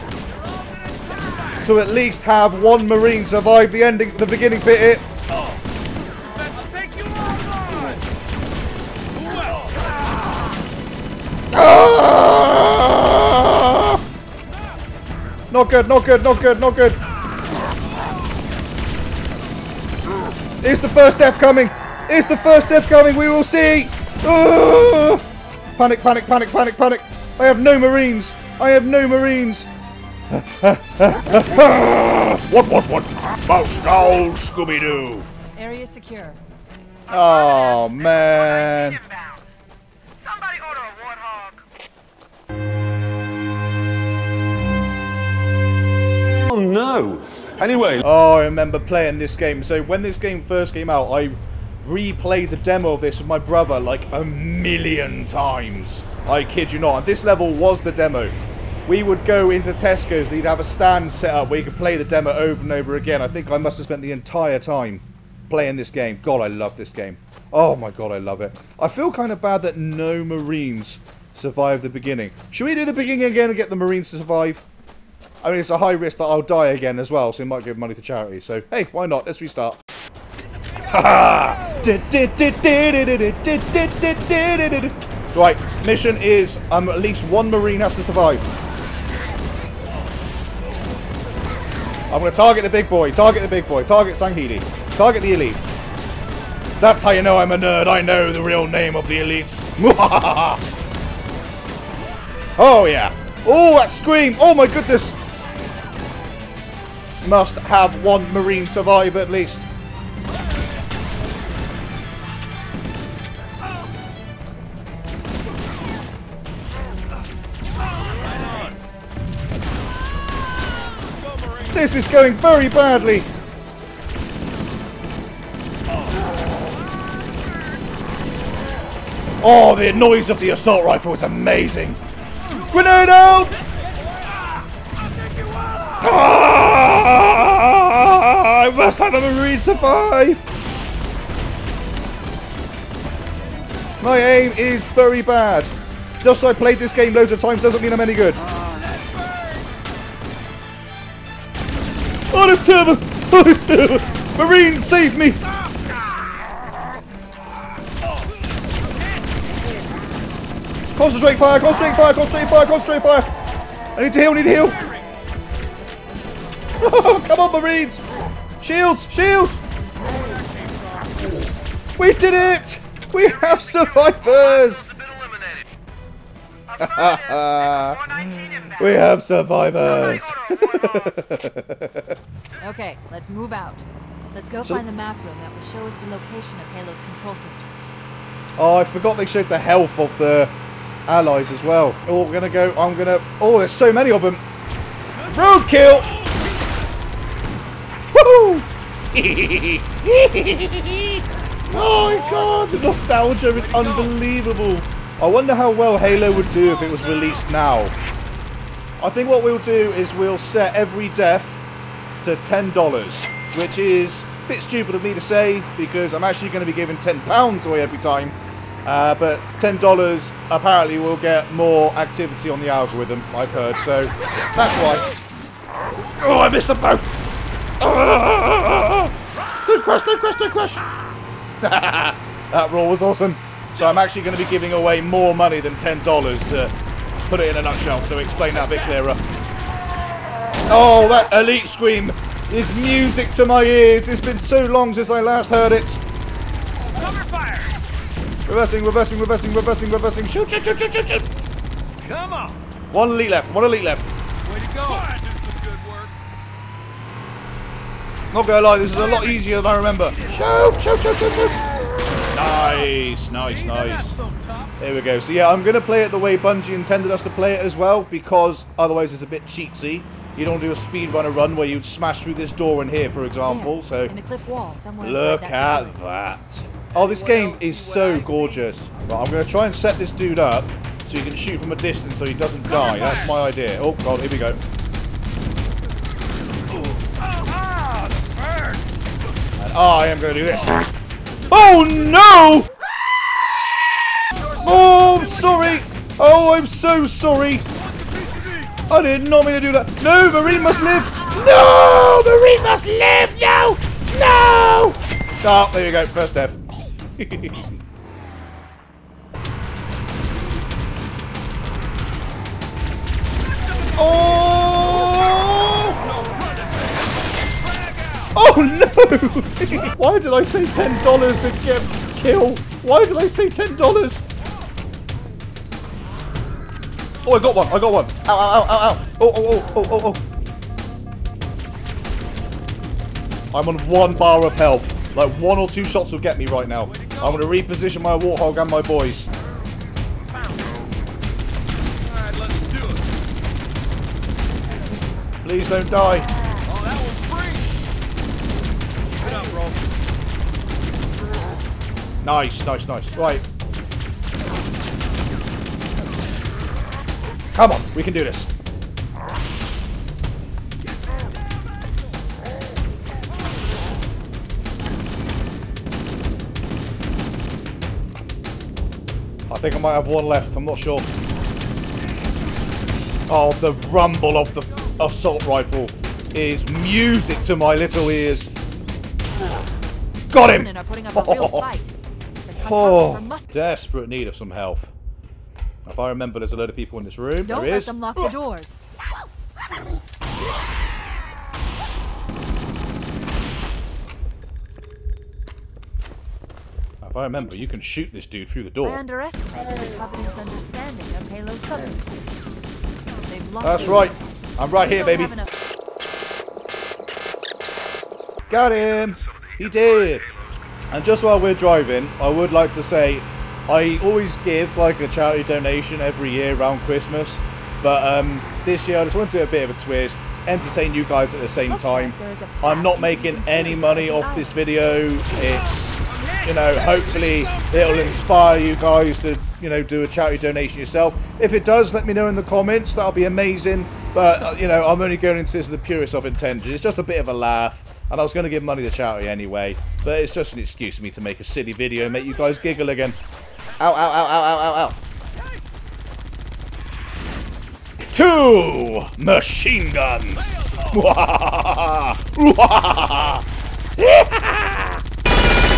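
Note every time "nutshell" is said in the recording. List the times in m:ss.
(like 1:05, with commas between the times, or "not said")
3:57.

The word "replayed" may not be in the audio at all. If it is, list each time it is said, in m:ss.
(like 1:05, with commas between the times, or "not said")
0:51.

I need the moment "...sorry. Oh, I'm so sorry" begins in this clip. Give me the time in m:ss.
4:55.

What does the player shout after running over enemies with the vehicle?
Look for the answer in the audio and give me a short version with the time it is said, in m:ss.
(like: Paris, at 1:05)
Roadkill, at 3:15.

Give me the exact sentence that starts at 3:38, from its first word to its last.
Uh, but $10 apparently will get more activity on the algorithm, I've heard, so that's why.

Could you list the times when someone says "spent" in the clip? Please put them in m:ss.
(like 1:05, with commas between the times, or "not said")
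1:03.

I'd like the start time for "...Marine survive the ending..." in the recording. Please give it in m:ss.
0:02.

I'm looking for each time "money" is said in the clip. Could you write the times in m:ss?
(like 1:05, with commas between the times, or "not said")
1:17, 3:55, 7:03, 7:18.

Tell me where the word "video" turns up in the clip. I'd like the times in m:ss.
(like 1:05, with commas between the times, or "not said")
7:04, 7:21.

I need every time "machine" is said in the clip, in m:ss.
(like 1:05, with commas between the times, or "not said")
7:29.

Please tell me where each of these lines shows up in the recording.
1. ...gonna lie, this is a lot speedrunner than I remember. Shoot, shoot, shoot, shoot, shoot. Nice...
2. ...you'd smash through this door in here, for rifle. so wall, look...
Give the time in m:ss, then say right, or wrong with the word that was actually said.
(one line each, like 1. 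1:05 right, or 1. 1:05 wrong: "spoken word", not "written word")
1. 4:18 wrong: "easier", not "speedrunner"
2. 4:31 wrong: "example", not "rifle".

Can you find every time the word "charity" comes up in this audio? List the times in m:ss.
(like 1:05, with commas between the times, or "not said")
1:18, 6:55, 7:10, 7:18.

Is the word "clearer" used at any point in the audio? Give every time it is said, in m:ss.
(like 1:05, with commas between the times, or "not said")
3:58.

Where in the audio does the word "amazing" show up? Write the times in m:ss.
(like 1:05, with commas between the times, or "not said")
2:11, 7:13.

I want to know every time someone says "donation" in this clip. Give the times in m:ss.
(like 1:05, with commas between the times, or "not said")
6:55, 7:10.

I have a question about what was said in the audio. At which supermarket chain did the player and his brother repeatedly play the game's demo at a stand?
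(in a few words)
Tesco's.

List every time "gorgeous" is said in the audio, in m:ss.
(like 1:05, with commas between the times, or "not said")
4:38.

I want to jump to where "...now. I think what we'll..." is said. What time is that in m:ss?
3:27.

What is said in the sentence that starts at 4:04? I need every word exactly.
It's been so long since I last heard it.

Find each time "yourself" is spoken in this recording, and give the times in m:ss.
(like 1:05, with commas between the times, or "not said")
7:10.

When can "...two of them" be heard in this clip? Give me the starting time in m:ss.
2:32.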